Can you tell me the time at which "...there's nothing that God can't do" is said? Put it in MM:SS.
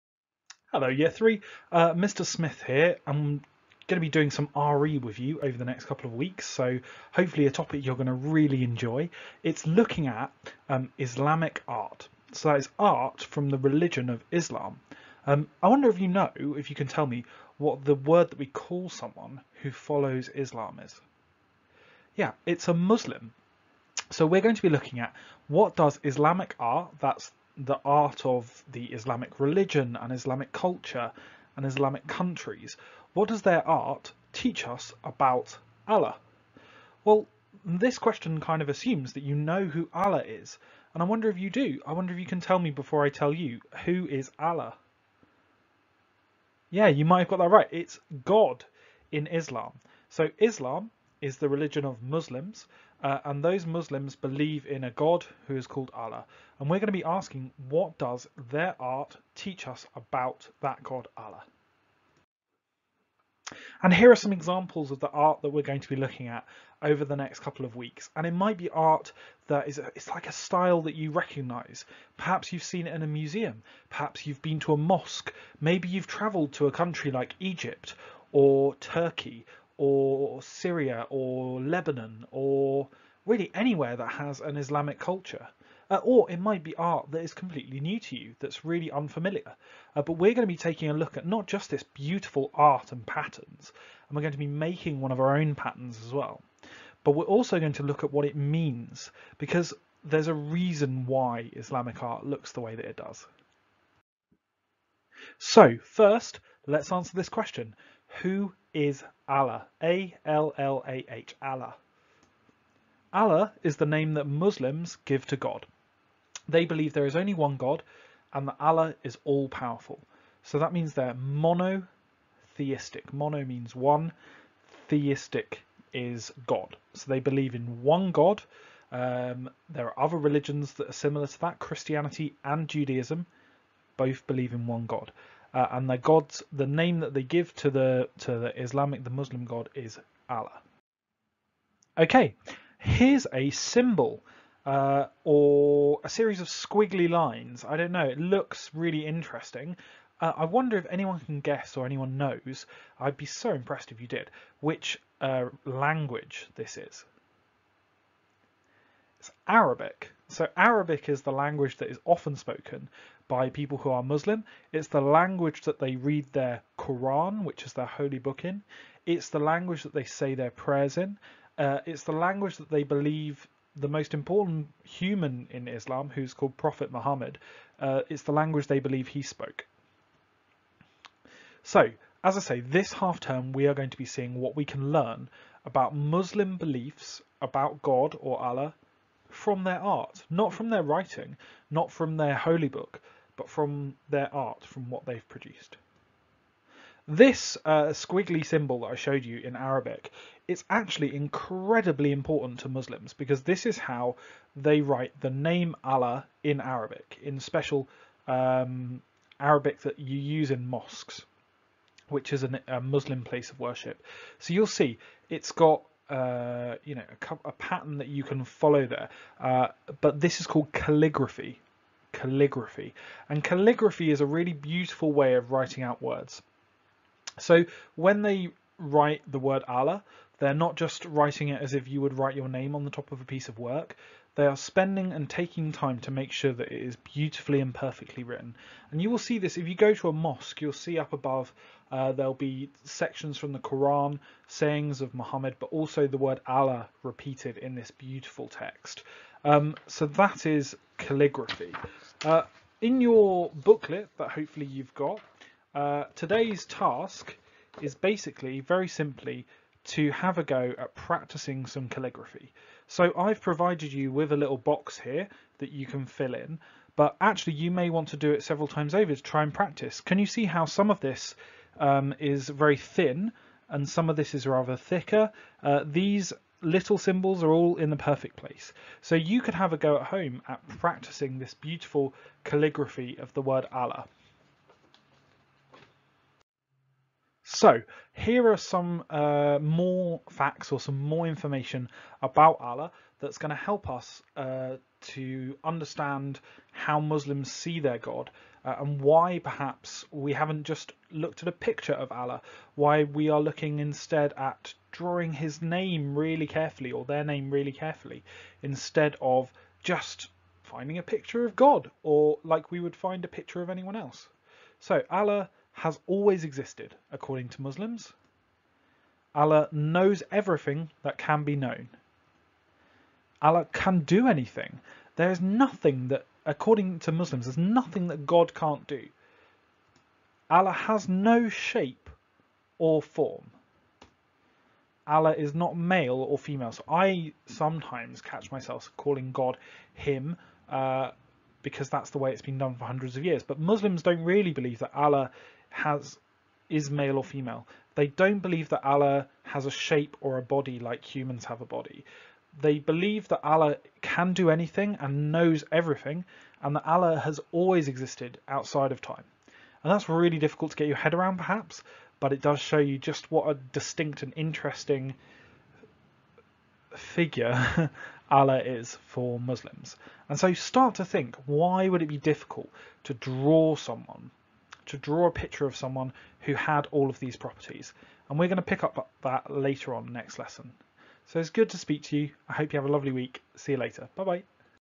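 05:27.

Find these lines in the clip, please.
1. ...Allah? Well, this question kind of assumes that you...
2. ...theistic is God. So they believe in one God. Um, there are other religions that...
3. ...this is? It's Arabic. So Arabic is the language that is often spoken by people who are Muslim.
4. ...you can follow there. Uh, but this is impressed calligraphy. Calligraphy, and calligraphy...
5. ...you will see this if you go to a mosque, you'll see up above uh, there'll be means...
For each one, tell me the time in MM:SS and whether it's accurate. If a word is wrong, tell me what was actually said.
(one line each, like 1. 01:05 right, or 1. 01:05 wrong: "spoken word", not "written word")
1. 00:35 right
2. 02:04 right
3. 02:36 right
4. 03:38 wrong: "called", not "impressed"
5. 03:58 wrong: "sections", not "means".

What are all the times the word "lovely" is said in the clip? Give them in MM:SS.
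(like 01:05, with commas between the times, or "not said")
06:22.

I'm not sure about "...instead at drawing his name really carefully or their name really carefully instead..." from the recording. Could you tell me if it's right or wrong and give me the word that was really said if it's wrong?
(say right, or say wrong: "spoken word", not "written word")
right.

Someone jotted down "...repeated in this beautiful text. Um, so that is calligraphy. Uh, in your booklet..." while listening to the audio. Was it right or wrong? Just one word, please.
right.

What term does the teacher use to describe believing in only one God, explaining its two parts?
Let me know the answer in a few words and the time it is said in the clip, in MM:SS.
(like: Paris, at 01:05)
monotheistic, at 02:01.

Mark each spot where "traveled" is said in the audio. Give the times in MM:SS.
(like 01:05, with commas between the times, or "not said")
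01:16.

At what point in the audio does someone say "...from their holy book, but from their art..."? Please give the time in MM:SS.
03:11.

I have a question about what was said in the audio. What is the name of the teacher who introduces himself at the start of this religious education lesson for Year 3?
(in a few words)
Mr. Smith.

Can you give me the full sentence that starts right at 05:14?
So Allah has always existed, according to Muslims.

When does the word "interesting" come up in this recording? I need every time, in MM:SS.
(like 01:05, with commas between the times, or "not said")
02:29, 06:04.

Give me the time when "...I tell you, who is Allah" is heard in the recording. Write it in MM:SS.
00:43.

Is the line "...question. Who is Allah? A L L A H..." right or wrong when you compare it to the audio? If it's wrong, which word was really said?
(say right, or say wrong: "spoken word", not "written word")
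right.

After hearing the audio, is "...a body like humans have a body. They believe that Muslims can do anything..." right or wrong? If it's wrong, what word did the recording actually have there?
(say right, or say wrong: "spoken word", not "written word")
wrong: "Allah", not "Muslims".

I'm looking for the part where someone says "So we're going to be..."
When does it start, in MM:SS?
00:24.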